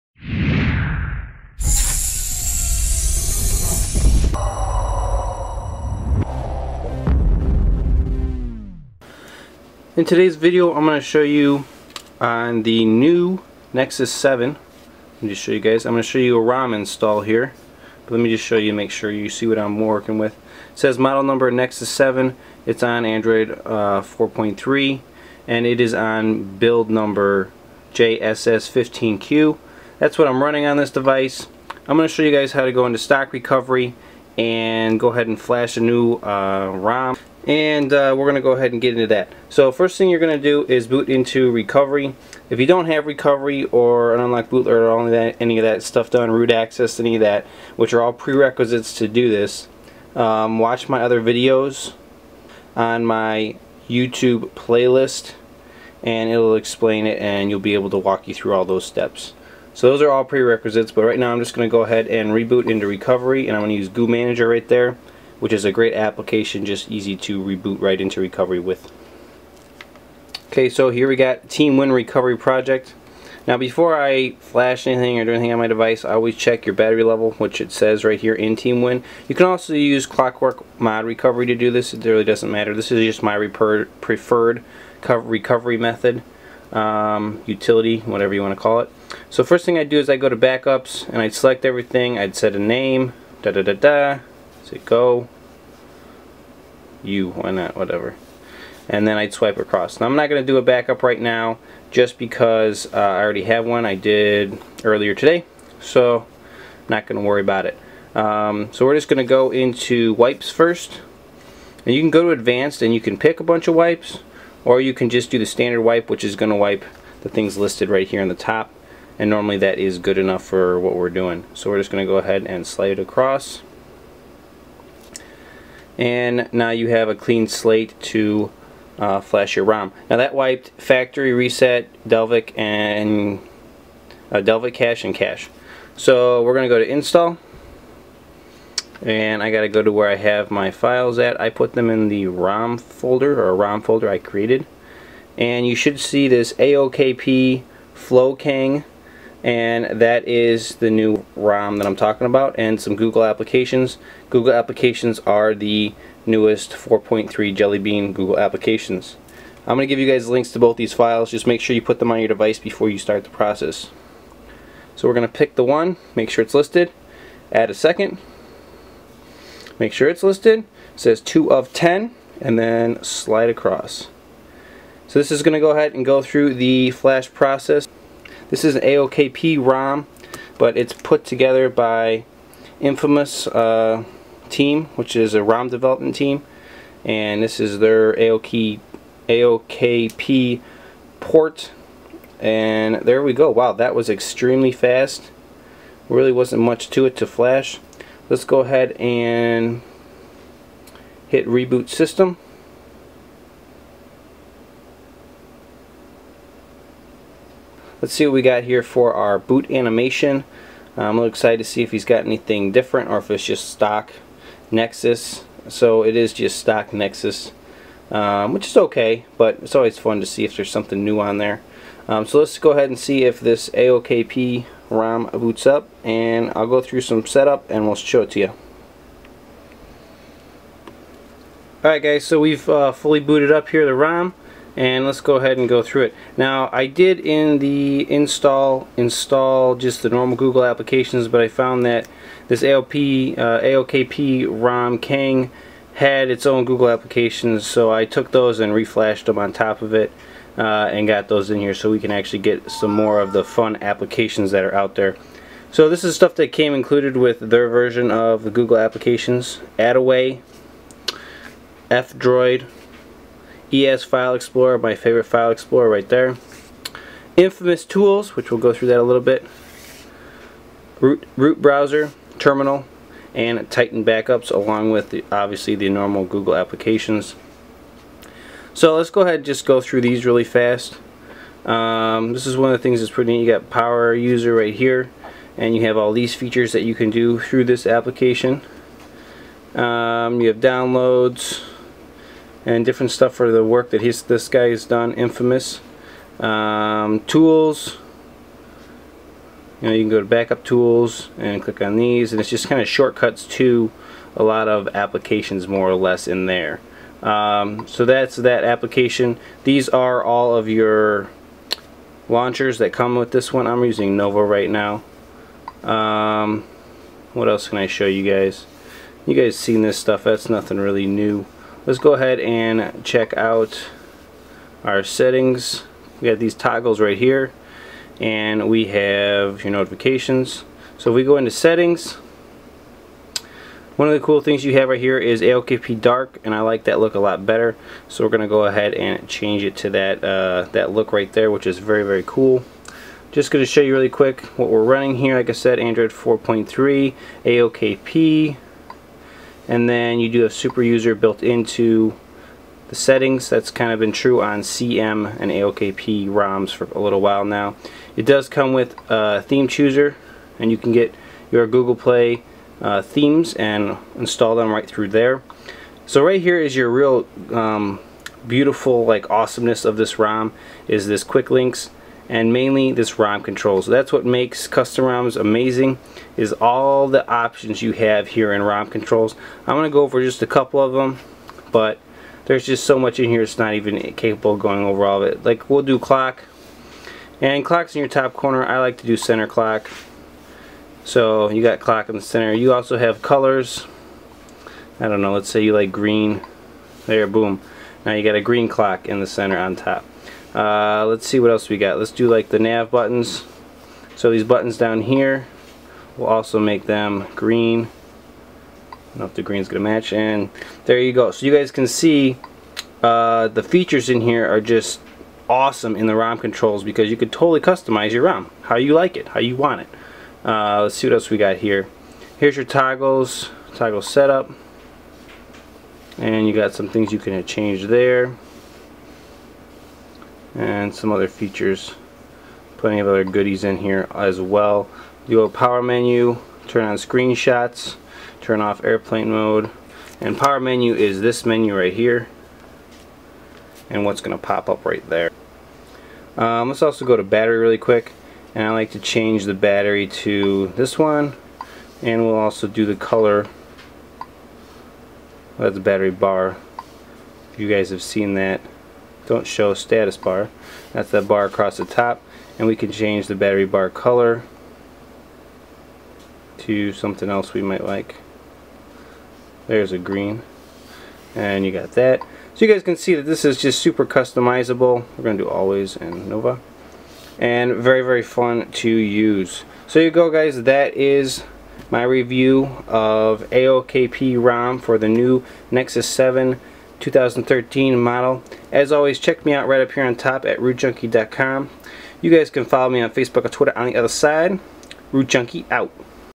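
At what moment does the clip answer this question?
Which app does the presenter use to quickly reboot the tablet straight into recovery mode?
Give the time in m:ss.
1:03.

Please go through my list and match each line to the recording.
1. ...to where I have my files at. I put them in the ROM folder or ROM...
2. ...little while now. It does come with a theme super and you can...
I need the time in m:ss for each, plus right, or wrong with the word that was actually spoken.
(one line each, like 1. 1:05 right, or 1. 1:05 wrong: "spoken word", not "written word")
1. 2:19 right
2. 5:56 wrong: "chooser", not "super".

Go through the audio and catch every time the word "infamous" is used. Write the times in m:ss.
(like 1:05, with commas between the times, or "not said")
3:02, 4:27, 4:55.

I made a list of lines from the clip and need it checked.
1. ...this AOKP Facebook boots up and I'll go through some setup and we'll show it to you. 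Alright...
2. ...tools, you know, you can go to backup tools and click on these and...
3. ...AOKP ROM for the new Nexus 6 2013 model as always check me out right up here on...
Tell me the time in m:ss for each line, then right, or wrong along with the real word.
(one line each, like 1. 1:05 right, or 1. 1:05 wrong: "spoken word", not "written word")
1. 3:43 wrong: "RAM", not "Facebook"
2. 4:57 right
3. 8:03 wrong: "7", not "6".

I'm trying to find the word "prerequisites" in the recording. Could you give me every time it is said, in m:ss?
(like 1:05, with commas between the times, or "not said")
0:48, 1:00.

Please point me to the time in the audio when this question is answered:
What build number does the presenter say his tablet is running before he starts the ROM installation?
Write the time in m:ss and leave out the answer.
0:27.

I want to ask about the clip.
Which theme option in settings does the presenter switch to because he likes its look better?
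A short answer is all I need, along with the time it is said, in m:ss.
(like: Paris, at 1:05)
AOKP dark, at 5:35.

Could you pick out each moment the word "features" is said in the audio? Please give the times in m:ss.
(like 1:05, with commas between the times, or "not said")
4:46, 6:53, 7:11.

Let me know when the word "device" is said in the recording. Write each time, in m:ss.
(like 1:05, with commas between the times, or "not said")
0:30, 1:15, 2:42.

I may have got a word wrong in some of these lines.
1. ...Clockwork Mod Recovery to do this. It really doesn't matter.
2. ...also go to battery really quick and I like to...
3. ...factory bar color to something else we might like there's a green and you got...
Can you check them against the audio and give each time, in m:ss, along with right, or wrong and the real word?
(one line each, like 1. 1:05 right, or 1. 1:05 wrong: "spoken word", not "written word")
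1. 1:20 right
2. 7:26 right
3. 7:43 wrong: "battery", not "factory".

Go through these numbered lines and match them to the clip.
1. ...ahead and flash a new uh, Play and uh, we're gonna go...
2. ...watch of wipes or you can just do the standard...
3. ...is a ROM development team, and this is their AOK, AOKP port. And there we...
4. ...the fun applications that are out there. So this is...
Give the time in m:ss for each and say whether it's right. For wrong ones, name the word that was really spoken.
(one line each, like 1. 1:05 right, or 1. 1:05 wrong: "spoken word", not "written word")
1. 0:35 wrong: "ROM", not "Play"
2. 1:53 wrong: "bunch", not "watch"
3. 3:05 right
4. 4:13 right.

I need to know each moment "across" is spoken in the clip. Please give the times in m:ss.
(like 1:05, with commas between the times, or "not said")
1:39, 2:02, 2:53, 7:41.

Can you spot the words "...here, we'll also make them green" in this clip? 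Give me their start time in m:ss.
6:45.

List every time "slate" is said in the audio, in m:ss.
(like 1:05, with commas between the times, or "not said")
2:07.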